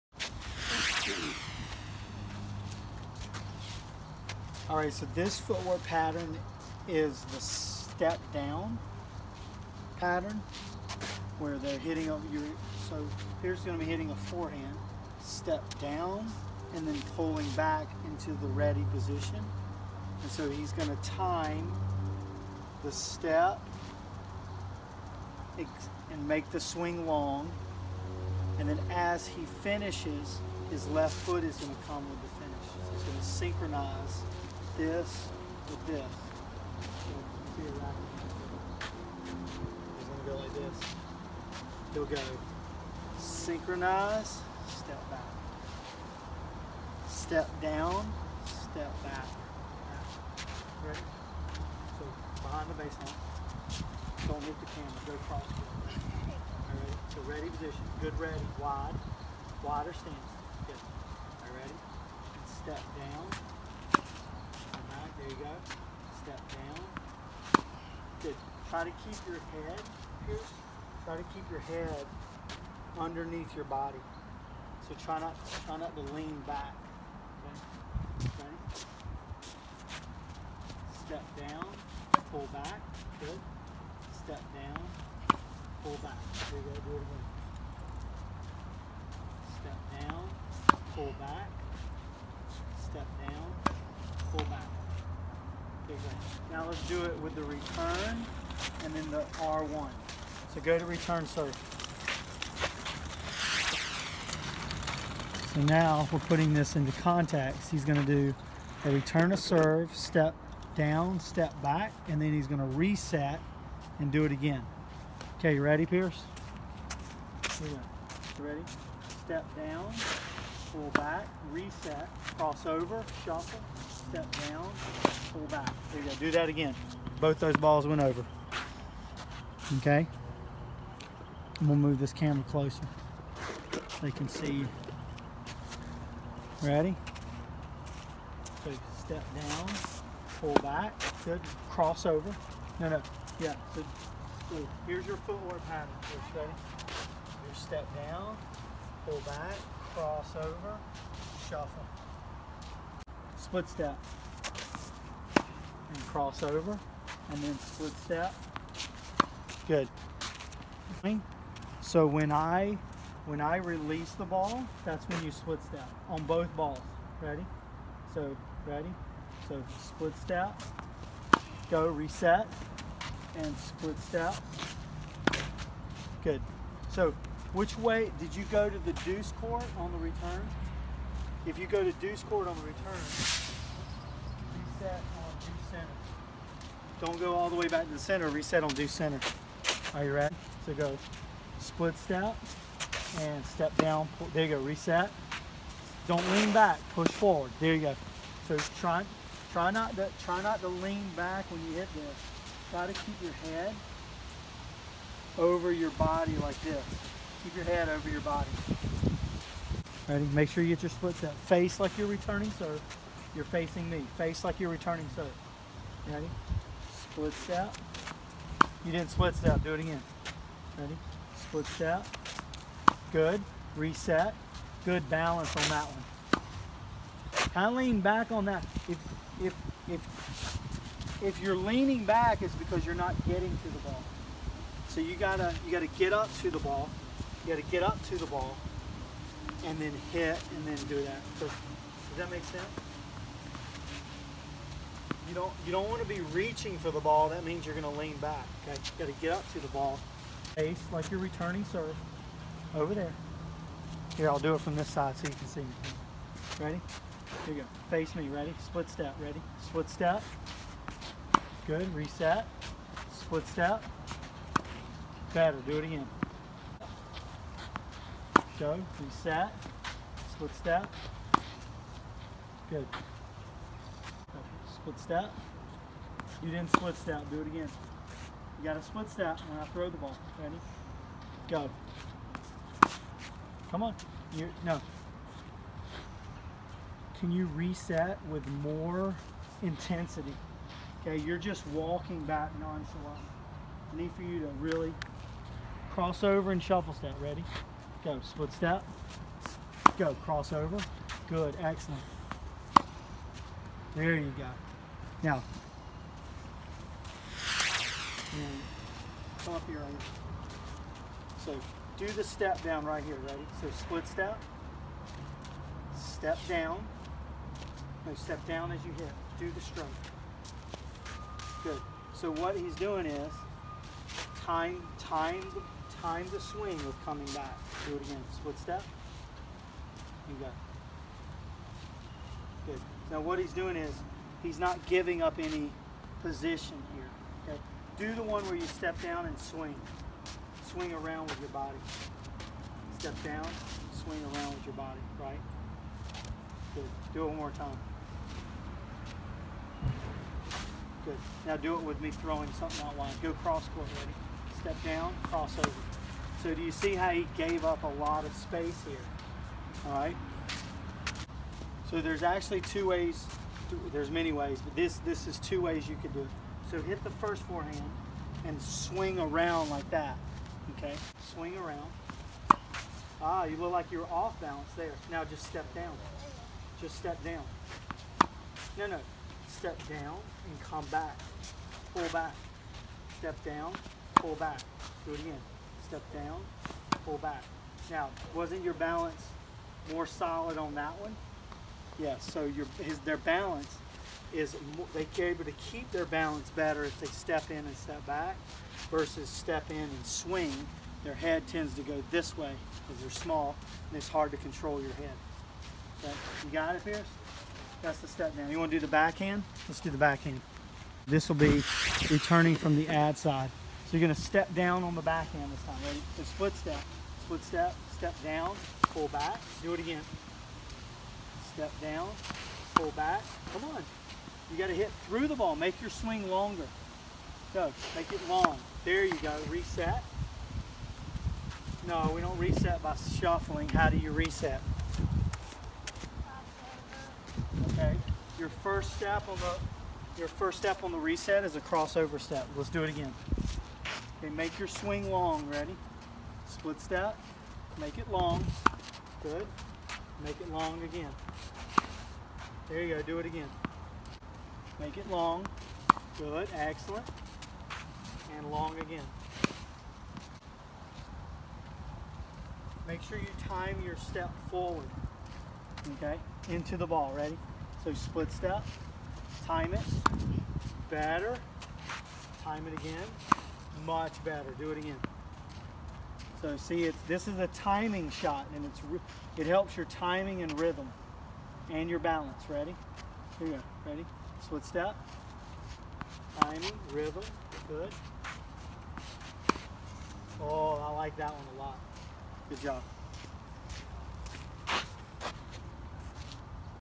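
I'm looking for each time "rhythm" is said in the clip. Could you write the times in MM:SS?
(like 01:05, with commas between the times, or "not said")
08:00, 08:06.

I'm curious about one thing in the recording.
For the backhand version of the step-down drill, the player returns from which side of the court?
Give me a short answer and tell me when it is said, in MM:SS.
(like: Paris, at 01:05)
The ad side, at 06:52.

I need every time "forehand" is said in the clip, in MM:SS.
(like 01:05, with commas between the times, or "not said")
00:14, 06:07.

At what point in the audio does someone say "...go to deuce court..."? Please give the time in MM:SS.
03:01.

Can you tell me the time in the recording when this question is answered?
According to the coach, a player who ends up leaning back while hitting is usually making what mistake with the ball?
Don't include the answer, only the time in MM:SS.
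04:06.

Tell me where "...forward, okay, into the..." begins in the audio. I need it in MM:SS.
07:44.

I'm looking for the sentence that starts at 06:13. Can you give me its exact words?
Ah, you look like you're off balance there.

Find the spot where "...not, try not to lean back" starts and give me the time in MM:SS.
01:15.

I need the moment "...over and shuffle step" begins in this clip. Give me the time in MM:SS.
04:56.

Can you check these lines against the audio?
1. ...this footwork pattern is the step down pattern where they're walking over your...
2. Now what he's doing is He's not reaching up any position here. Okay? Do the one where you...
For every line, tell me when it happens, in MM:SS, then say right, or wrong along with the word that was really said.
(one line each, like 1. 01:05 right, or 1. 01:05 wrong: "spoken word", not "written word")
1. 00:05 wrong: "hitting", not "walking"
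2. 05:33 wrong: "giving", not "reaching".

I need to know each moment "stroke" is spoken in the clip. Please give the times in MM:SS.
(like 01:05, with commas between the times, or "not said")
05:19.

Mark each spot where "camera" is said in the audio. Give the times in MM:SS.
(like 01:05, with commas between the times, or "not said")
00:54, 02:12.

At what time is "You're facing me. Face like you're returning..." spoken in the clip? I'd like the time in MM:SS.
03:33.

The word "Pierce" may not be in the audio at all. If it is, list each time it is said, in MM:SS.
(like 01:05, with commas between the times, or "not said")
01:10, 01:55, 06:46.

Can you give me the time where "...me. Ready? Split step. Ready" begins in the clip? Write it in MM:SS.
04:18.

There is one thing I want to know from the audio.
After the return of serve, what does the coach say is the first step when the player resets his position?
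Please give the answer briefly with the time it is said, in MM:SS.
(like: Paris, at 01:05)
Crossover step, at 07:21.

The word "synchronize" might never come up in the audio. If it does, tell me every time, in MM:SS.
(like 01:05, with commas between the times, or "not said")
00:33, 00:43.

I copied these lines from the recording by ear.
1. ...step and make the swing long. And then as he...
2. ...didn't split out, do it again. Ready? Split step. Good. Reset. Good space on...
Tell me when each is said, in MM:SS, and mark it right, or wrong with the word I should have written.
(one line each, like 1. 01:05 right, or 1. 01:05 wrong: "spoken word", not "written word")
1. 00:22 right
2. 03:38 wrong: "balance", not "space".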